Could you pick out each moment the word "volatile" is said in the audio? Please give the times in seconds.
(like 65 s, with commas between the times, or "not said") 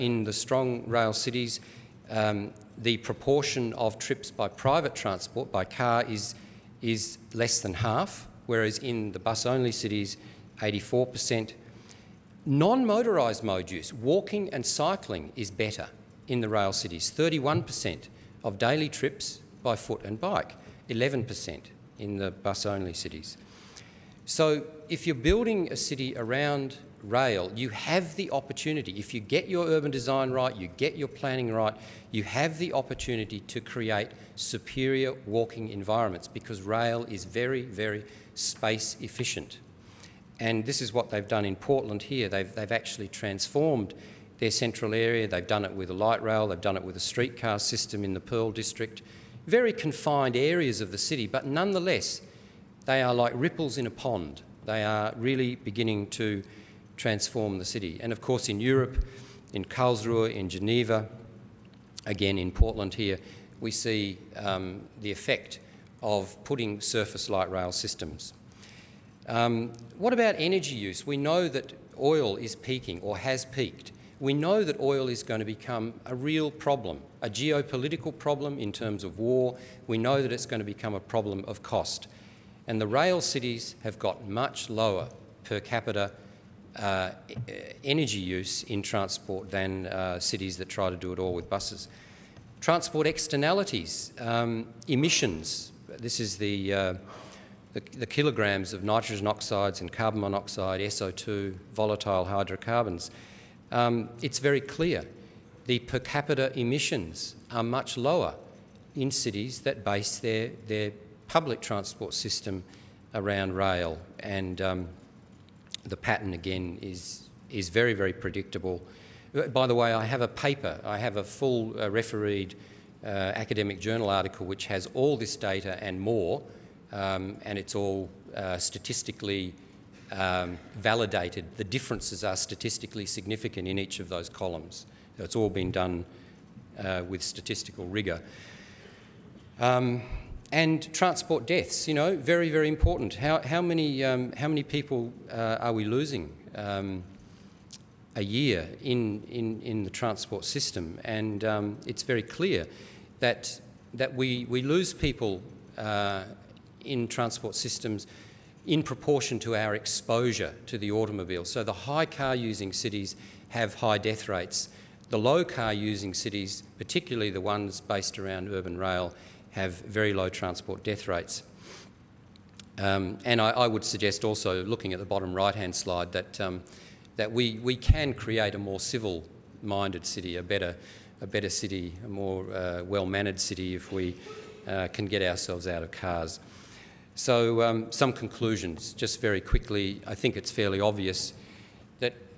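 101 s.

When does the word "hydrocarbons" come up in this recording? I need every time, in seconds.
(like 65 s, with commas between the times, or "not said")
102 s.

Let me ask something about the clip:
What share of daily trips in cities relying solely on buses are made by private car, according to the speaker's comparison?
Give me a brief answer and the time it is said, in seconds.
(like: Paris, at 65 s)
84%, at 10 s.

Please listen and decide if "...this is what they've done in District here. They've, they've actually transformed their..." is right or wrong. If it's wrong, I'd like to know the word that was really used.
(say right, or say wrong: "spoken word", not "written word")
wrong: "Portland", not "District".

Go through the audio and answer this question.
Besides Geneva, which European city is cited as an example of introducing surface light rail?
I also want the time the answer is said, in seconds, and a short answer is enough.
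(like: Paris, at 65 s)
Karlsruhe, at 59 s.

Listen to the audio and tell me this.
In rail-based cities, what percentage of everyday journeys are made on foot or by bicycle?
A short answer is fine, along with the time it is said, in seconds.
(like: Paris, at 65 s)
31%, at 17 s.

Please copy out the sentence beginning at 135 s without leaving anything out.
it's all been done uh, with statistical rigour.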